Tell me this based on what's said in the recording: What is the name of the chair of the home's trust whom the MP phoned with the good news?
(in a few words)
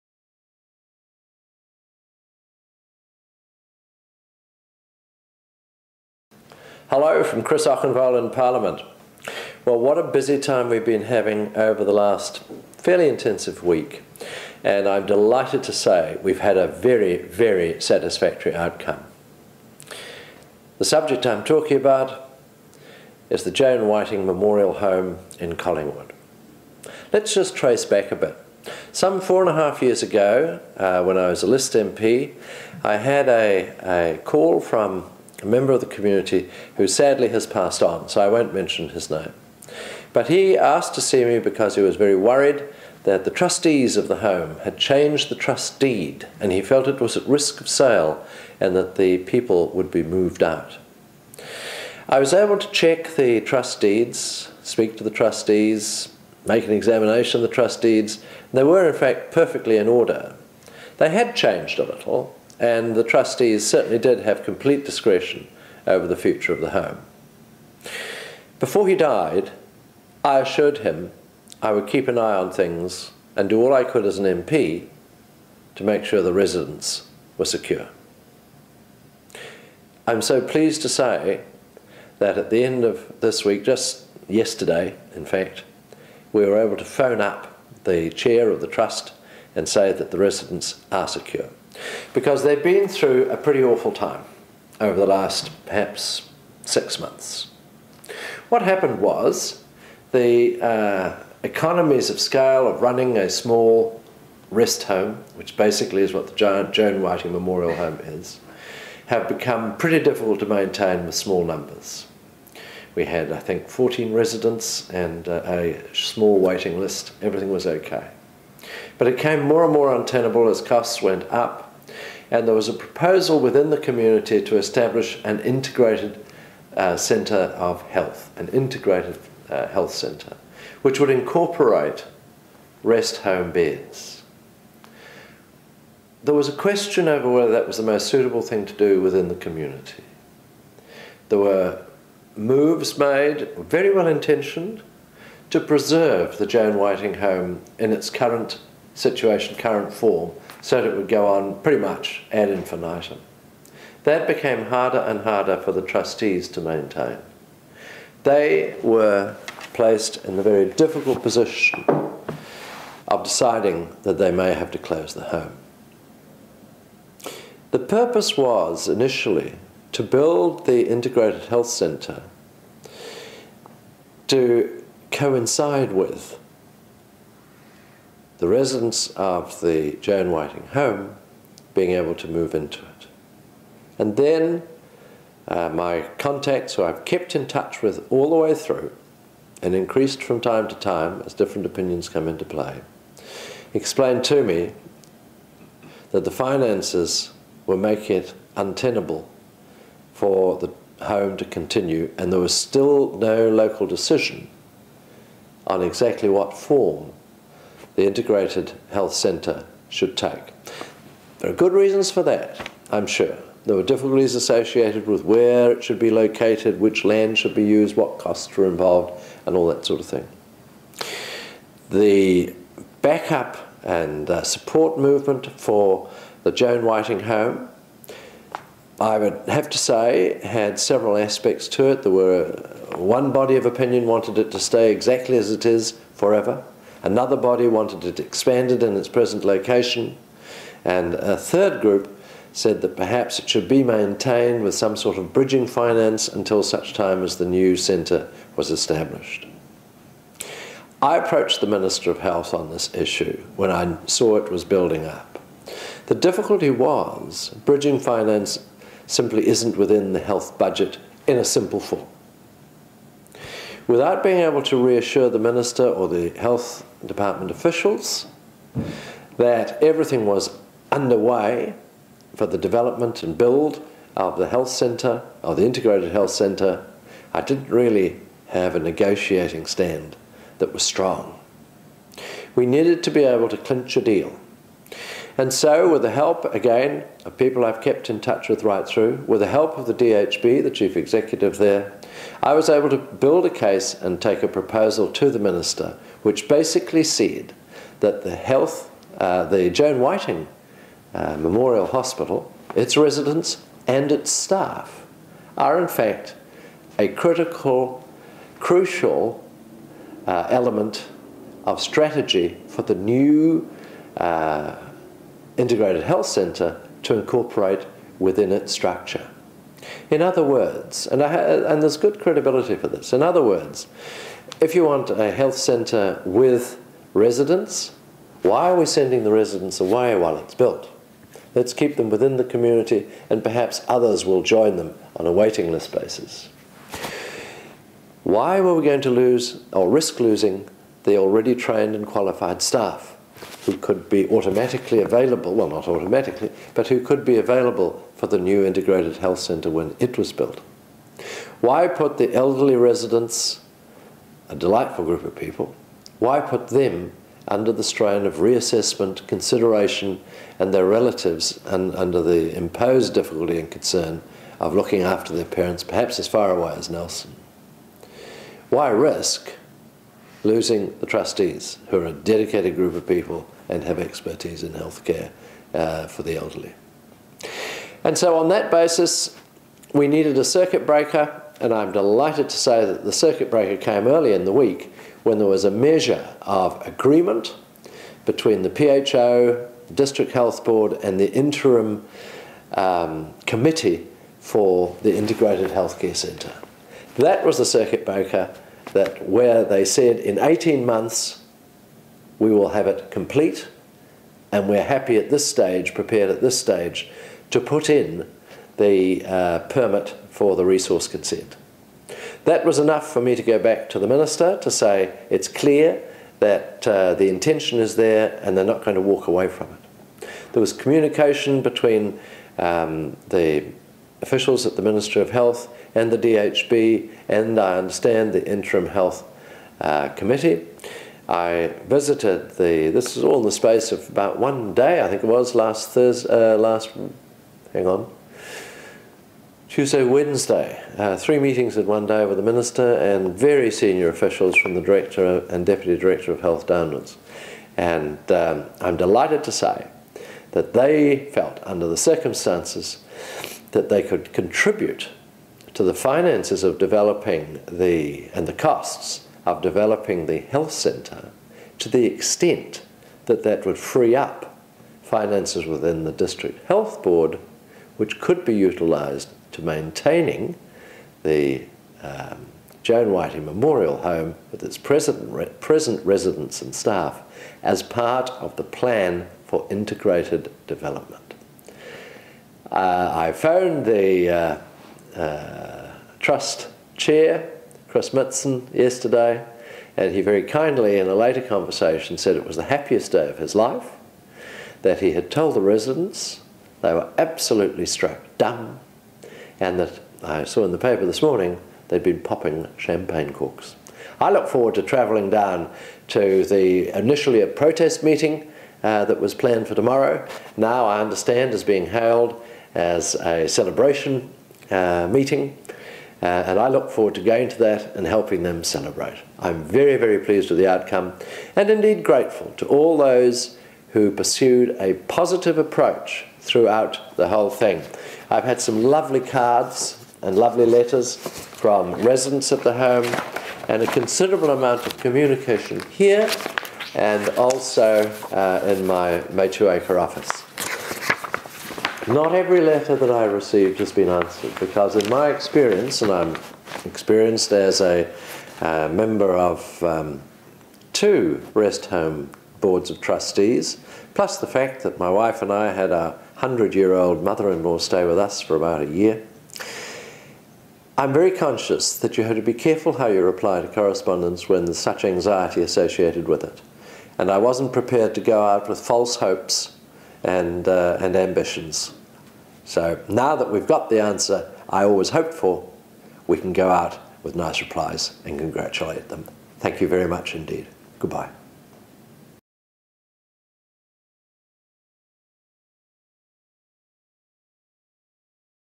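Chris Mitson.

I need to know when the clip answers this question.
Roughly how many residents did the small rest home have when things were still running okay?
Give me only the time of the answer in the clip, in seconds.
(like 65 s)
113 s.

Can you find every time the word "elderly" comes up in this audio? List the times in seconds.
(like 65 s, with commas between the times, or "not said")
352 s, 376 s.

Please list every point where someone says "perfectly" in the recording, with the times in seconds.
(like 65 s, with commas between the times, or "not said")
59 s.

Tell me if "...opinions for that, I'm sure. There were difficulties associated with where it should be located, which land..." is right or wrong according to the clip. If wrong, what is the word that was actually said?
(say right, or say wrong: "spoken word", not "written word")
wrong: "reasons", not "opinions".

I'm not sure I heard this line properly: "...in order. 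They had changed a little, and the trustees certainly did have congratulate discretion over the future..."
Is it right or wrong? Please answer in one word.
wrong.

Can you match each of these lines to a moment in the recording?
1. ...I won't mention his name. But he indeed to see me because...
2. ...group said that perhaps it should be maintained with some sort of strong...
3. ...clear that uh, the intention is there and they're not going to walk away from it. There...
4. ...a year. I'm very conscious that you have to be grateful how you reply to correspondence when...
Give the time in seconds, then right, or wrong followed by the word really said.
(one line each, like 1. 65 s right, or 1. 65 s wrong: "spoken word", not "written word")
1. 38 s wrong: "asked", not "indeed"
2. 241 s wrong: "bridging", not "strong"
3. 415 s right
4. 558 s wrong: "careful", not "grateful".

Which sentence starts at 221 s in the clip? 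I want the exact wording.
The backup and uh, support movement for the Joan Whiting home, I would have to say, had several aspects to it.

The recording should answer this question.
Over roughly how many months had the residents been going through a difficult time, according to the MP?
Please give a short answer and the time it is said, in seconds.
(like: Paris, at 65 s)
6, at 96 s.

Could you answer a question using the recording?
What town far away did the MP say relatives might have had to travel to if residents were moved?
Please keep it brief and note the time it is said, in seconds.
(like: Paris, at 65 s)
Nelson, at 366 s.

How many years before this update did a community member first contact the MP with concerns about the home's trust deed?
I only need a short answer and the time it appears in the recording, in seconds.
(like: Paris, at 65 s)
4 and a half, at 29 s.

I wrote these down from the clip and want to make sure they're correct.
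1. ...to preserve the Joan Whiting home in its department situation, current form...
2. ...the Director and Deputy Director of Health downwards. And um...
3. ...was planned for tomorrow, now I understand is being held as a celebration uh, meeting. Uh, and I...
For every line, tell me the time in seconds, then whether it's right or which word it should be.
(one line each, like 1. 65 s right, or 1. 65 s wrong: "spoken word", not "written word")
1. 145 s wrong: "current", not "department"
2. 444 s right
3. 509 s right.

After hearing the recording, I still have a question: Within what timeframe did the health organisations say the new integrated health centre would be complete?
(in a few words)
18 months.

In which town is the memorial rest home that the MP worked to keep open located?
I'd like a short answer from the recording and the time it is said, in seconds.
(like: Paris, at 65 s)
Collingwood, at 25 s.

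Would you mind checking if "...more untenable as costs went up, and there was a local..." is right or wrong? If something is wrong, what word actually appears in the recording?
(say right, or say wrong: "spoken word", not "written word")
wrong: "proposal", not "local".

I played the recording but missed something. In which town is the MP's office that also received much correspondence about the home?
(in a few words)
Takaka.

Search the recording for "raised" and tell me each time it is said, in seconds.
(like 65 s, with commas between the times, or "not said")
not said.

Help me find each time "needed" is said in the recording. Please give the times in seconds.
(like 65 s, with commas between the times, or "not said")
282 s, 380 s.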